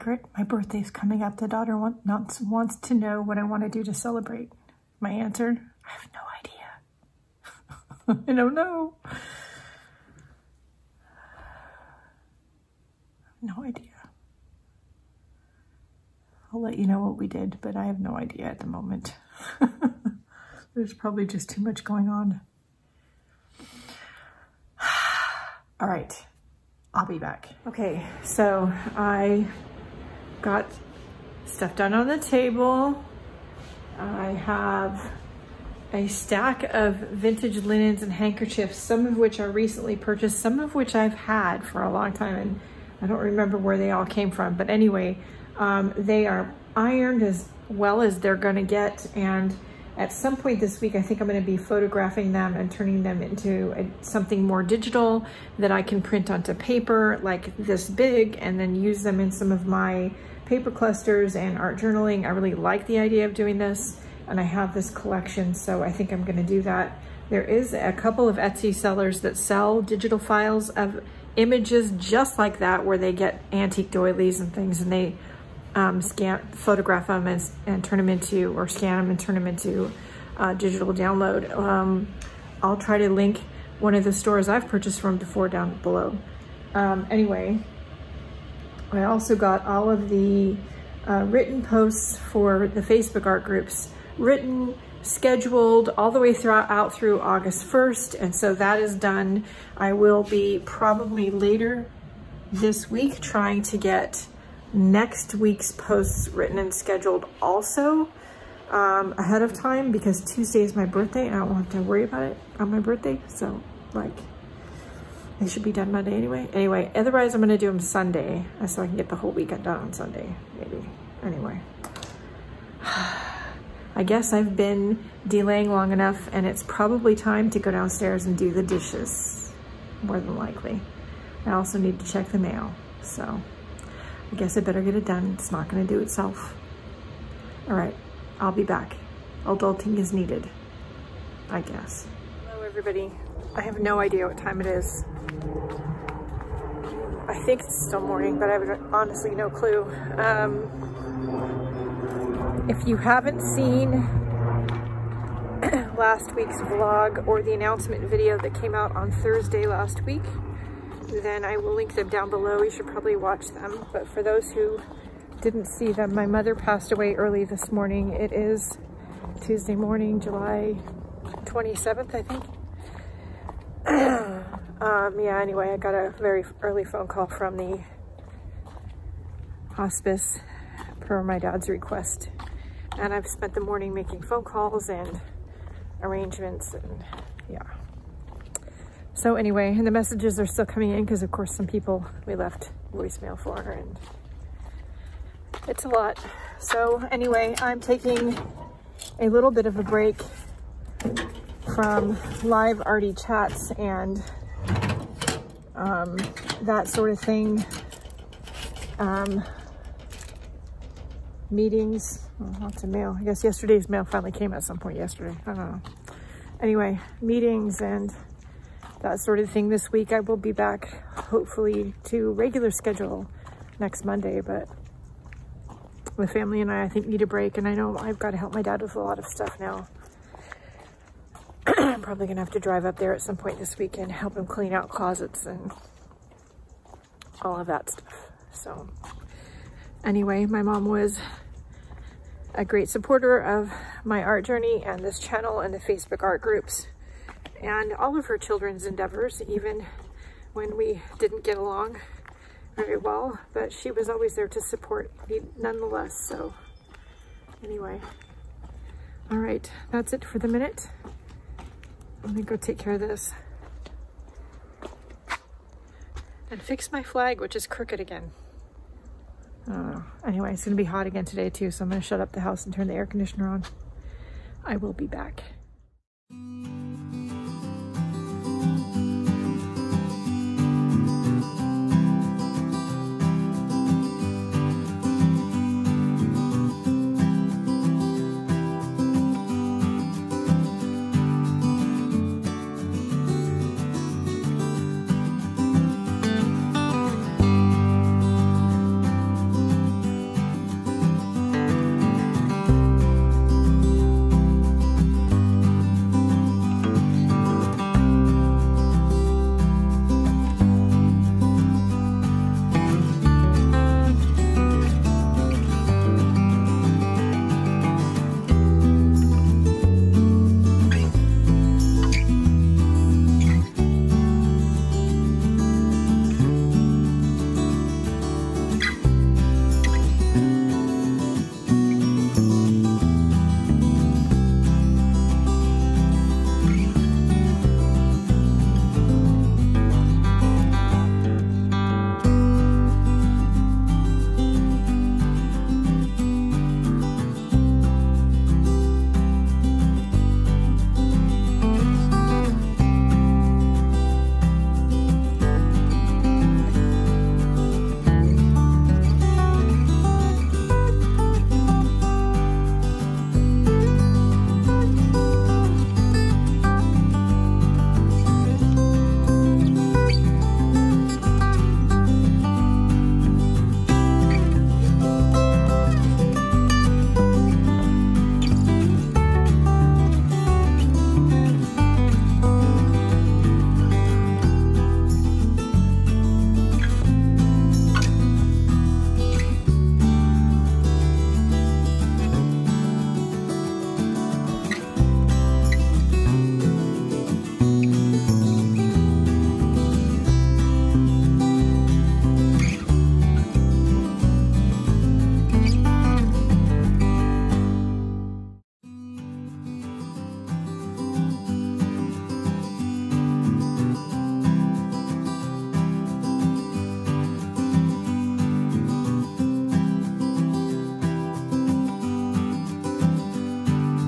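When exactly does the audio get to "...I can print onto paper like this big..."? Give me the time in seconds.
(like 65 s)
55 s.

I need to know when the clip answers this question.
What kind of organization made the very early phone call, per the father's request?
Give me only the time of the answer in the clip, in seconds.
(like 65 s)
179 s.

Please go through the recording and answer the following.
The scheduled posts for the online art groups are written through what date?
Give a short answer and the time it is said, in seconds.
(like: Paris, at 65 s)
August 1st, at 97 s.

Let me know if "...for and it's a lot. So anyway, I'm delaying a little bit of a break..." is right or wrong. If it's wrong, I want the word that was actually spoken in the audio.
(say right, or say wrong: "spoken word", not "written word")
wrong: "taking", not "delaying".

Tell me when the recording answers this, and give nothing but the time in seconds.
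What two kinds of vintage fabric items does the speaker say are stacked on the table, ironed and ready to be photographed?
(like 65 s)
36 s.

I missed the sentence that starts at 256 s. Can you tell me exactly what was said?
So anyway, all right, that's it for the minute.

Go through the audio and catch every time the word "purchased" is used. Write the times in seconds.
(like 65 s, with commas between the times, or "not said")
39 s, 84 s.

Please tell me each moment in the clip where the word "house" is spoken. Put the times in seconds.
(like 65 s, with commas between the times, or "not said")
272 s.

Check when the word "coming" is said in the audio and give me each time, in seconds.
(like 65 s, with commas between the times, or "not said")
0 s, 190 s.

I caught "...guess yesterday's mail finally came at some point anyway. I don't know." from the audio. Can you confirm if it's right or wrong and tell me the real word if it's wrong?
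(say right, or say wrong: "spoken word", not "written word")
wrong: "yesterday", not "anyway".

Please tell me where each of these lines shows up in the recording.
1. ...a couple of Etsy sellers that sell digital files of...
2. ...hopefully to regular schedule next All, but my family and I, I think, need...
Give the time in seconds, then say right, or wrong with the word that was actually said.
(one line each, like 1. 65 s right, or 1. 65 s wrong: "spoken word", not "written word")
1. 67 s right
2. 221 s wrong: "Monday", not "All".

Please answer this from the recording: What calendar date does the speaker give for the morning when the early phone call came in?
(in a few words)
July 27th.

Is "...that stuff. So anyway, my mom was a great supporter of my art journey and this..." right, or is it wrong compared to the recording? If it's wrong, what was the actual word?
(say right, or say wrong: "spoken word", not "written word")
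right.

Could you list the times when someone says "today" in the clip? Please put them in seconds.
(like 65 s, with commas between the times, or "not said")
271 s.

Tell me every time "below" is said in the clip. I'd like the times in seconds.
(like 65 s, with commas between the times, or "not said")
85 s, 162 s.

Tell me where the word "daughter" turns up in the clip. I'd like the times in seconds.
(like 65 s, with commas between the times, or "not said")
1 s.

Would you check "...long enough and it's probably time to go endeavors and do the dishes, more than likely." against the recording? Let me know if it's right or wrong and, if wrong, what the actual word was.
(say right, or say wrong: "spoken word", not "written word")
wrong: "downstairs", not "endeavors".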